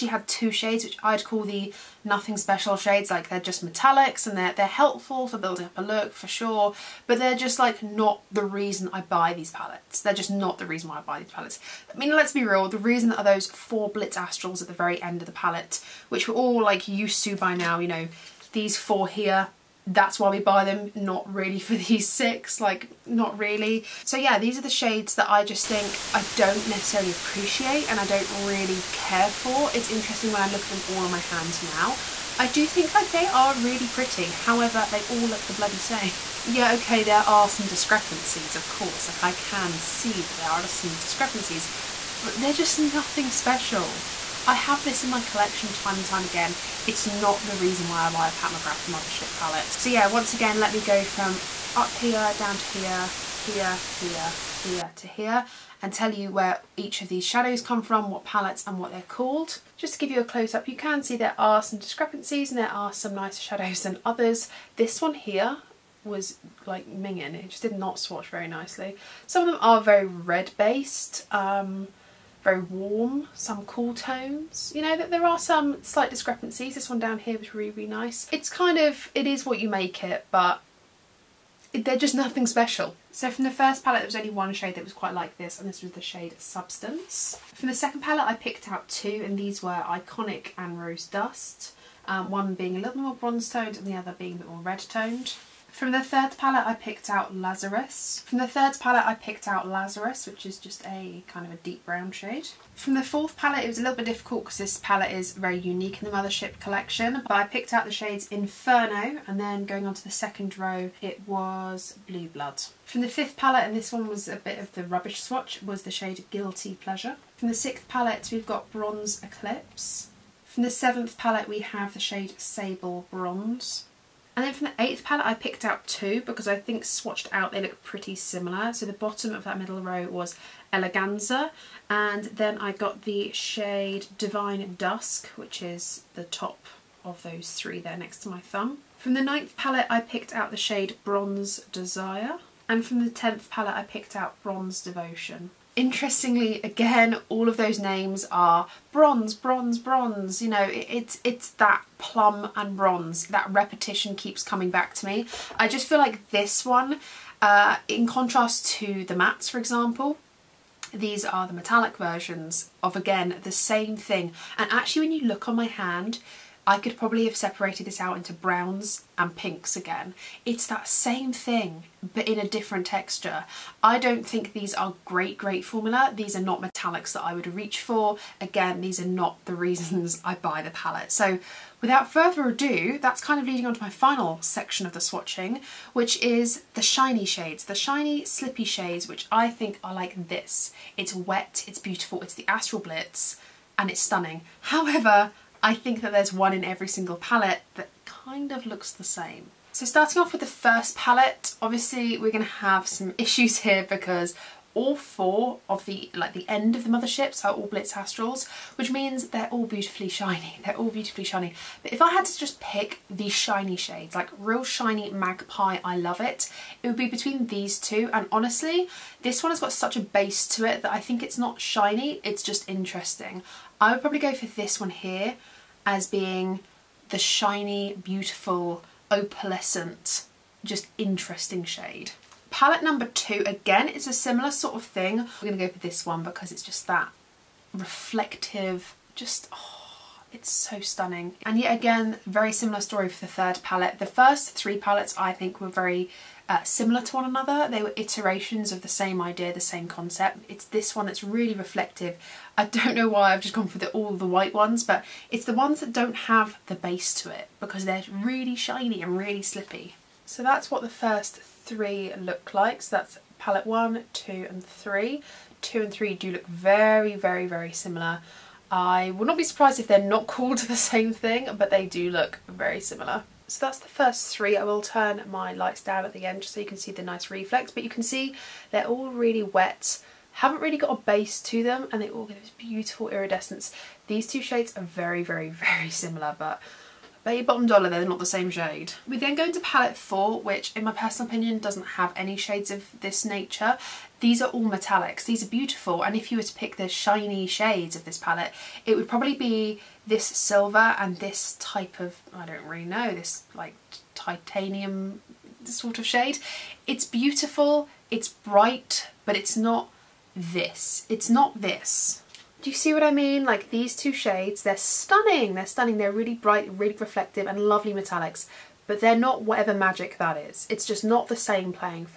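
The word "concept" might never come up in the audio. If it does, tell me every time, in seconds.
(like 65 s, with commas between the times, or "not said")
249 s.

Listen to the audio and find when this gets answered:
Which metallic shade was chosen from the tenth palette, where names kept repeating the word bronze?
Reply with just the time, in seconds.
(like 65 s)
144 s.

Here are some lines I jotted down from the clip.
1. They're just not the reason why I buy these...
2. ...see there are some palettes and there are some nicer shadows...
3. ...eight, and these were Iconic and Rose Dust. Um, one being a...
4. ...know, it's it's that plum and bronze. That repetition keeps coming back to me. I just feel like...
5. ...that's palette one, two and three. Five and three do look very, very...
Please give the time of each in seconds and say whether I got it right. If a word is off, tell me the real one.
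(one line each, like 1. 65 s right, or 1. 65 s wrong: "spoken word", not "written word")
1. 10 s right
2. 61 s wrong: "discrepancies", not "palettes"
3. 88 s wrong: "two", not "eight"
4. 150 s right
5. 262 s wrong: "Two", not "Five".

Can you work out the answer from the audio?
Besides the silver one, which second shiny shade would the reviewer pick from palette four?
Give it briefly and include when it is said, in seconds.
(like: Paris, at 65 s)
titanium, at 304 s.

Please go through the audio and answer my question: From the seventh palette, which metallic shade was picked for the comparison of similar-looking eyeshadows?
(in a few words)
Sable Bronze.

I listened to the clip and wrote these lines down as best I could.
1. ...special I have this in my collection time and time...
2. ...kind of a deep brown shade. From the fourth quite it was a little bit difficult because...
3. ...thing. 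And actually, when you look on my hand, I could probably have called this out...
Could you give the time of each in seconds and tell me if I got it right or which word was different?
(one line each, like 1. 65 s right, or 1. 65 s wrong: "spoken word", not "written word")
1. 43 s right
2. 101 s wrong: "palette", not "quite"
3. 163 s wrong: "separated", not "called".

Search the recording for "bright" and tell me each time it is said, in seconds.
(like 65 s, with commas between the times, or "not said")
308 s, 316 s.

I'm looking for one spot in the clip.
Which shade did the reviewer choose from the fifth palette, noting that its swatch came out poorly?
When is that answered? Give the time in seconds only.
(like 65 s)
116 s.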